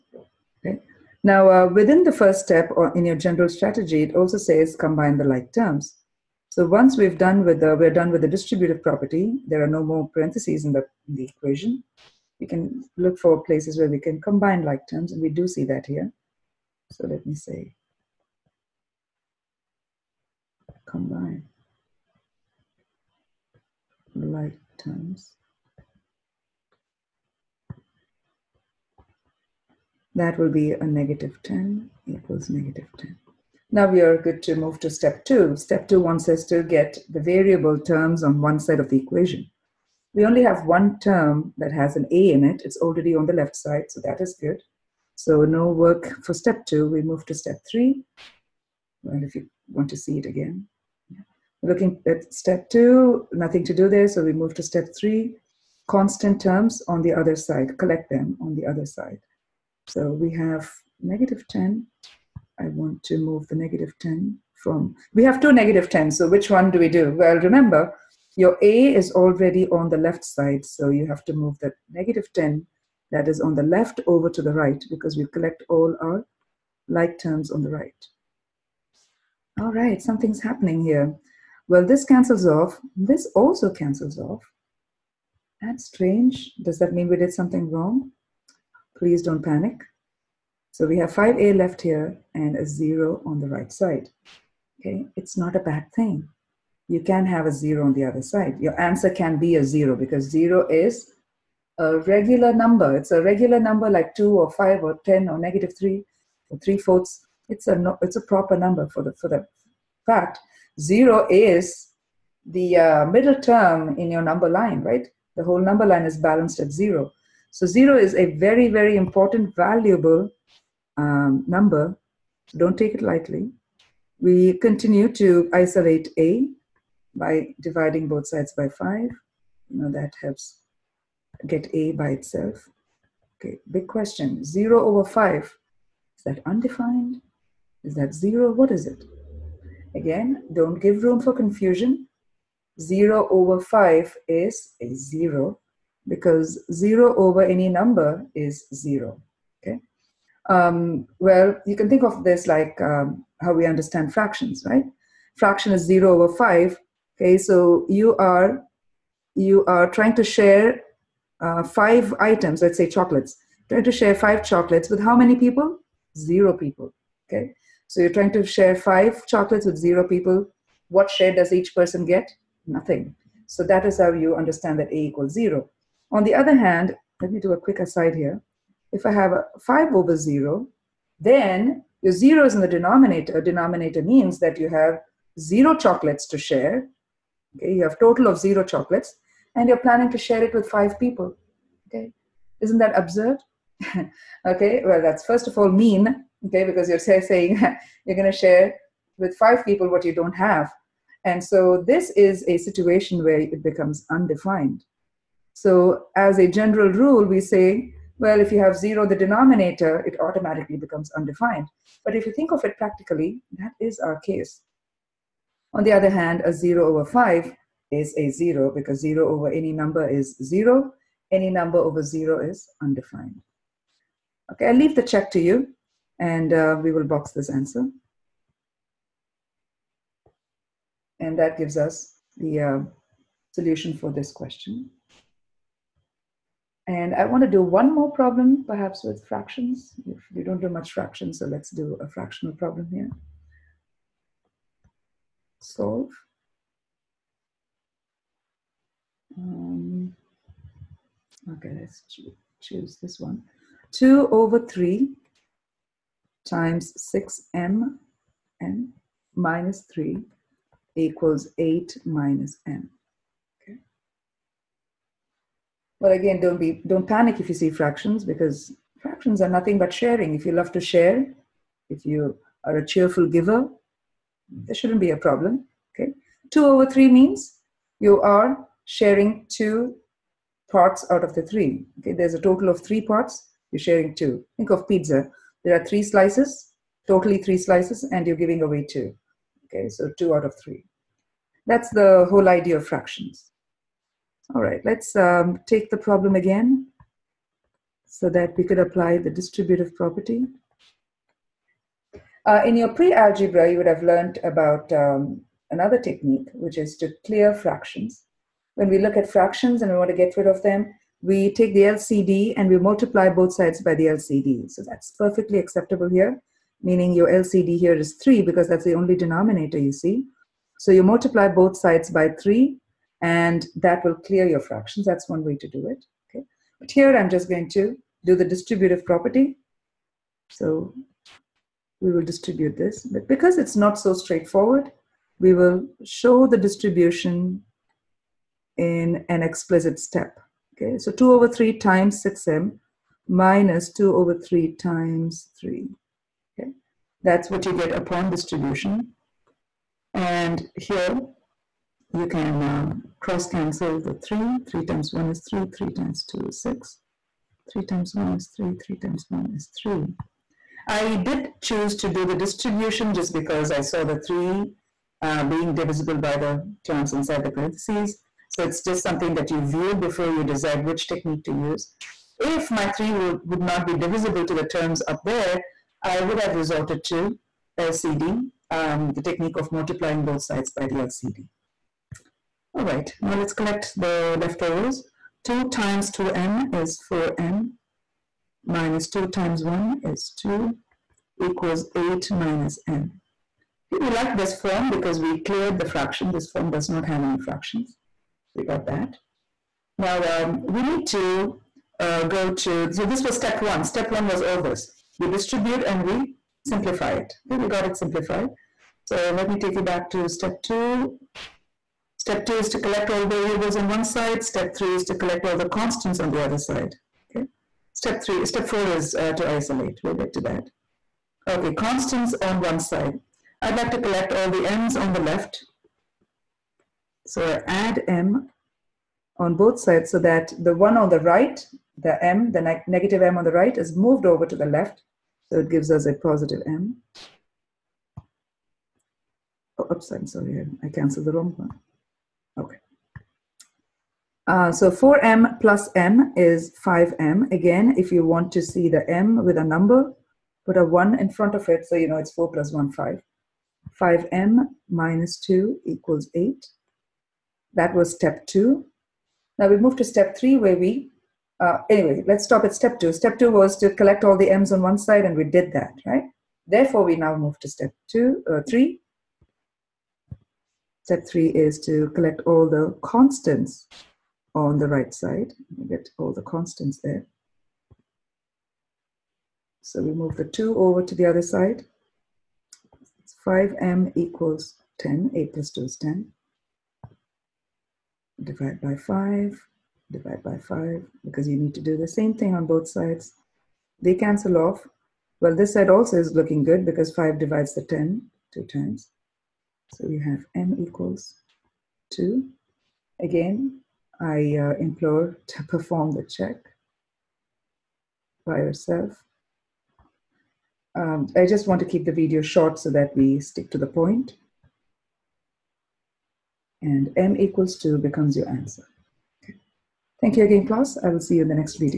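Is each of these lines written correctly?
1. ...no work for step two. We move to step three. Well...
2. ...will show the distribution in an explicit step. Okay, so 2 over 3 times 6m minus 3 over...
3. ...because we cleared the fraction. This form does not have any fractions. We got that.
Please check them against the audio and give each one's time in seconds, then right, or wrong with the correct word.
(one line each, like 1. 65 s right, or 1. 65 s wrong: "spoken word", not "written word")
1. 45 s right
2. 335 s wrong: "2", not "3"
3. 394 s right.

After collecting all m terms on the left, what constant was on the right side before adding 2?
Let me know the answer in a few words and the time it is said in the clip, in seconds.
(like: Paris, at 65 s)
8, at 453 s.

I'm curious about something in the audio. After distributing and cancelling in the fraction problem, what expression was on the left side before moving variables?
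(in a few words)
4m - 2.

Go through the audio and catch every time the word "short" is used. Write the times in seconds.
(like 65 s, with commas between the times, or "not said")
512 s.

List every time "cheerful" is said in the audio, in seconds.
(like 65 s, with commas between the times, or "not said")
272 s.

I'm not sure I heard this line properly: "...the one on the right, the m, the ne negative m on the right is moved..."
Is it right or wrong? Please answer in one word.
right.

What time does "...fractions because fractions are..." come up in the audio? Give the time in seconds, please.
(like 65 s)
267 s.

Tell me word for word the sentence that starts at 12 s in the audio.
We can look for places where we can combine like terms, and we do see that here.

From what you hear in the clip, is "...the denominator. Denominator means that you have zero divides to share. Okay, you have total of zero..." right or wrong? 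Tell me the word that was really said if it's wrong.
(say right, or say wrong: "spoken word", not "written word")
wrong: "chocolates", not "divides".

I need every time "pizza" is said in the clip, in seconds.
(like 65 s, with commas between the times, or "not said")
284 s.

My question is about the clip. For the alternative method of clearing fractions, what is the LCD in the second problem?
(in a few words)
3.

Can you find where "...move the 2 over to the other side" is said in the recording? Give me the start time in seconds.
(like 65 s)
480 s.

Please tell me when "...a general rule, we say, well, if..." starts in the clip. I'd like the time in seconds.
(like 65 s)
206 s.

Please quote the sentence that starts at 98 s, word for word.
Your answer can be a 0 because 0 is a regular number.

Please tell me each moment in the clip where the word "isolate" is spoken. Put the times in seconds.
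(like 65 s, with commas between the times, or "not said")
125 s, 419 s.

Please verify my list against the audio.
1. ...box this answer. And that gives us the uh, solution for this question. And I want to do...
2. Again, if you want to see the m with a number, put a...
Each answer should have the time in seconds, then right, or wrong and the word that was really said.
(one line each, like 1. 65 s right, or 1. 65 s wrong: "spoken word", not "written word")
1. 227 s right
2. 447 s right.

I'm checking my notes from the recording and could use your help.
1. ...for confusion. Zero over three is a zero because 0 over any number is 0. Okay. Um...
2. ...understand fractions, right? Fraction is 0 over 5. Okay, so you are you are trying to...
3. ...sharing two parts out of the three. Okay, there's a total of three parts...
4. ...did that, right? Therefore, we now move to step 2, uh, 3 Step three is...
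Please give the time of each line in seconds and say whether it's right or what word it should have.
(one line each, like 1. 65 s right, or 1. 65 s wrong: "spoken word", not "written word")
1. 141 s wrong: "five", not "three"
2. 153 s right
3. 278 s right
4. 465 s right.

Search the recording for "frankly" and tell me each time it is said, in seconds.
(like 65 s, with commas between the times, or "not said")
not said.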